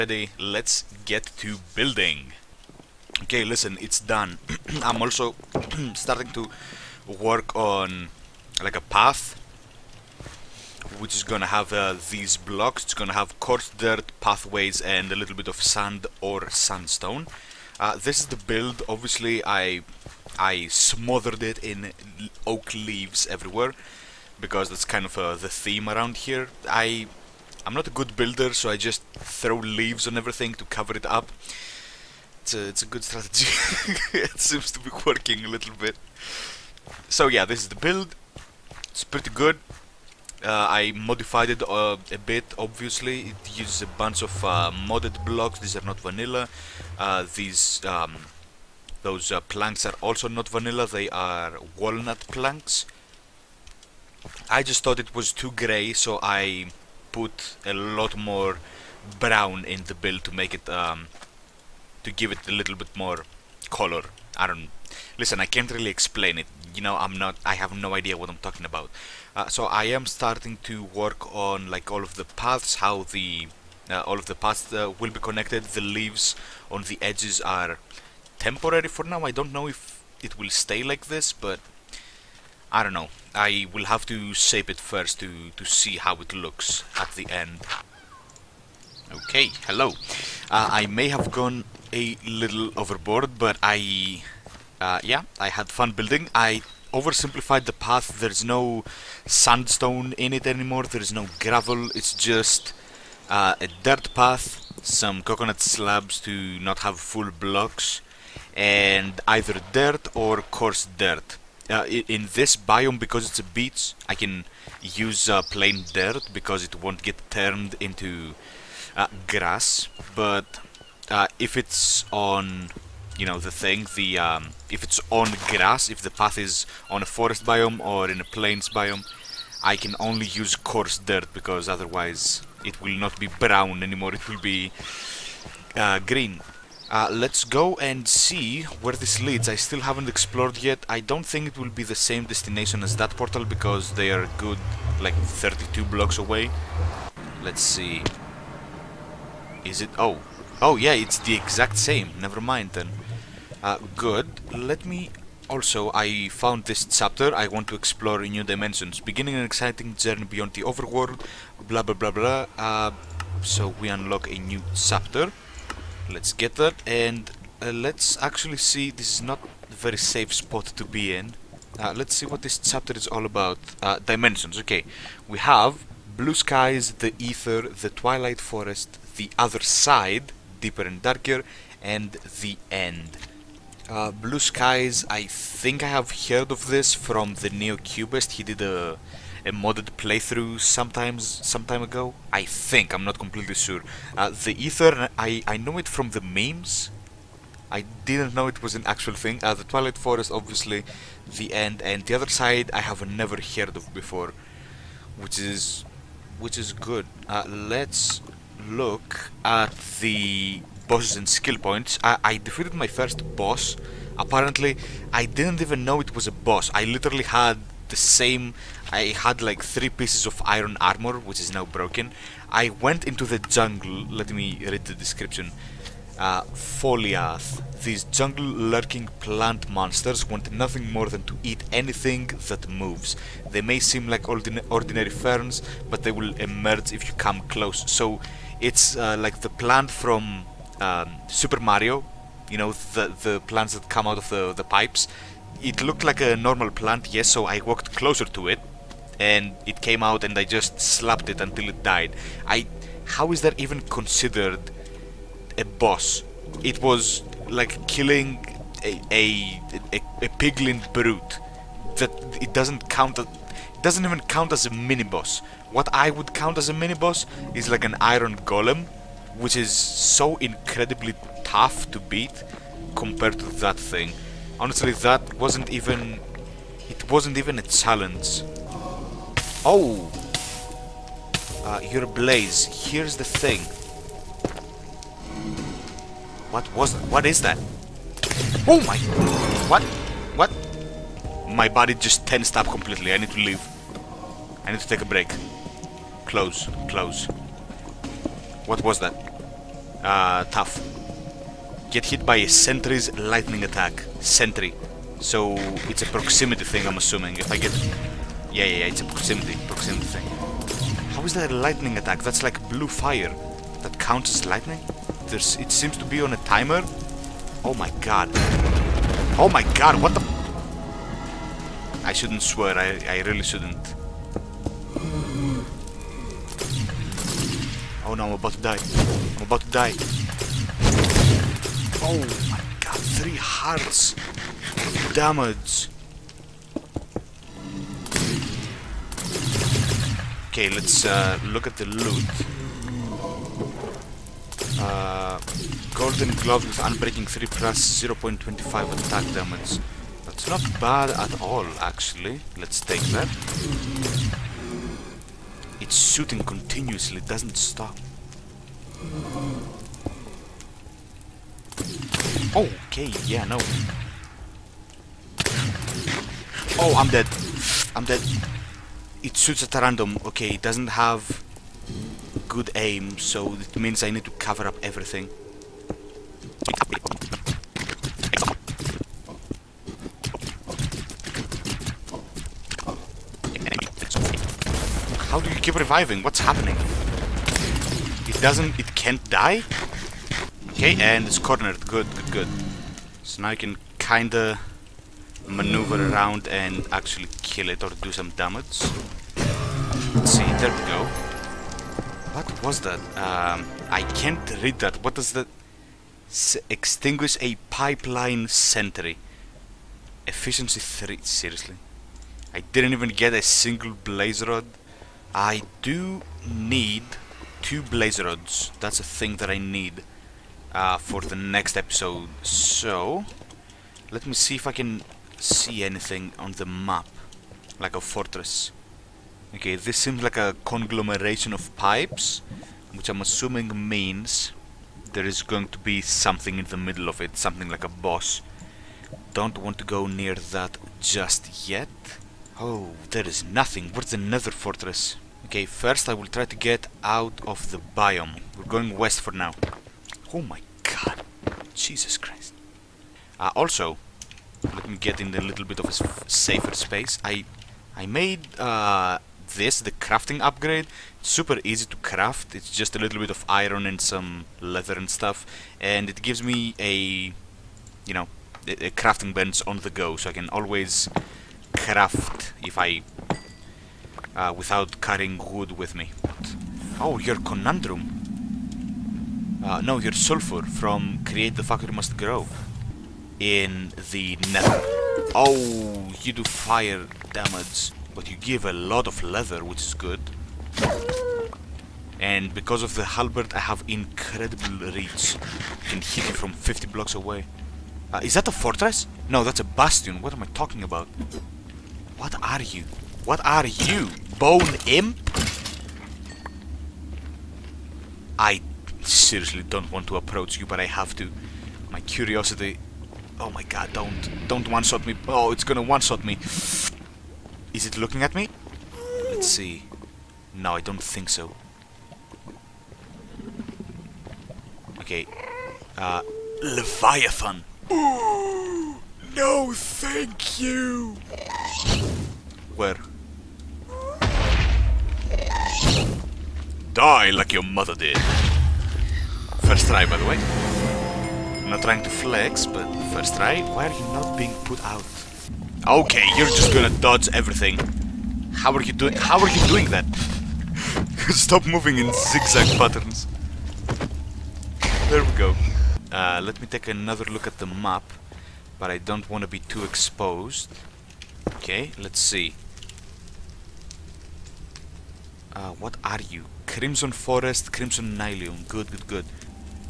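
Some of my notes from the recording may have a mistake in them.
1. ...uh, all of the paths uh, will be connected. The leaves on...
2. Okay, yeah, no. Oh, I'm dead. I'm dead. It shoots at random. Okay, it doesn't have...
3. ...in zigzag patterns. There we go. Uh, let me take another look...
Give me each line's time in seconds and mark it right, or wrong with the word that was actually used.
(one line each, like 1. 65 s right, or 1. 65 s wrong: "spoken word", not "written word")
1. 73 s right
2. 362 s right
3. 551 s right.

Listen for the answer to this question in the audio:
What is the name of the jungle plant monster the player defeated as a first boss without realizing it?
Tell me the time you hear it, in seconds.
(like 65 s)
226 s.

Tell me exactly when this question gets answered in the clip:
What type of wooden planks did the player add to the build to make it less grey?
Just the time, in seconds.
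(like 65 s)
51 s.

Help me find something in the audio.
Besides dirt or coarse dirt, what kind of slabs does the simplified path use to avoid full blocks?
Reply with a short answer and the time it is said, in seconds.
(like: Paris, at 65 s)
Coconut slabs, at 105 s.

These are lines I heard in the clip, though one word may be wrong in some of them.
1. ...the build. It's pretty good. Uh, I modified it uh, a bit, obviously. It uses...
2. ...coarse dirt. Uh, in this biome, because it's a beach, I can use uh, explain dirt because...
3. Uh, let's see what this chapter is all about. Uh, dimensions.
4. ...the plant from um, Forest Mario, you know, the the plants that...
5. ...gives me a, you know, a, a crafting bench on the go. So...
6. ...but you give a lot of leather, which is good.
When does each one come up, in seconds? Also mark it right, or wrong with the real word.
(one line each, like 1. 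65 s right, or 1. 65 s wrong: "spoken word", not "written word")
1. 37 s right
2. 110 s wrong: "plain", not "explain"
3. 171 s right
4. 239 s wrong: "Super", not "Forest"
5. 466 s right
6. 488 s right.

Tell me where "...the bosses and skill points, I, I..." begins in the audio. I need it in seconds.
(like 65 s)
210 s.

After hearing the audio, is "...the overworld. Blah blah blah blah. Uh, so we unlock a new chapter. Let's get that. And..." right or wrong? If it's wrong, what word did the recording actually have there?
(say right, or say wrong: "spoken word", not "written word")
right.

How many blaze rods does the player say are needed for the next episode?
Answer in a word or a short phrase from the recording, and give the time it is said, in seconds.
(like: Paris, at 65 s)
2, at 417 s.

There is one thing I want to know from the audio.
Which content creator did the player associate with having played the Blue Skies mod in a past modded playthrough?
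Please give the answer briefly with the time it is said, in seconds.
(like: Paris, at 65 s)
Neocubest, at 187 s.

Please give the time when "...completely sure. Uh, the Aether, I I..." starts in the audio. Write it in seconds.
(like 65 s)
193 s.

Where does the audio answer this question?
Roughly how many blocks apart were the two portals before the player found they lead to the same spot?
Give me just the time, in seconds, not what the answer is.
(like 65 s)
145 s.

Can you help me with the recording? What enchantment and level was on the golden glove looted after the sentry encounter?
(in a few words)
Unbreaking 3.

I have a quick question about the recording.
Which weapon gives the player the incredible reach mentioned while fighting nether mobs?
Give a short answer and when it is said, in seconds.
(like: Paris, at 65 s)
Halberd, at 493 s.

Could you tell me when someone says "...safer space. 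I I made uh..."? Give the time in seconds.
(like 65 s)
456 s.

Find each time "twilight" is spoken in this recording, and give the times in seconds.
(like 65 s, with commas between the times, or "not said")
177 s, 199 s.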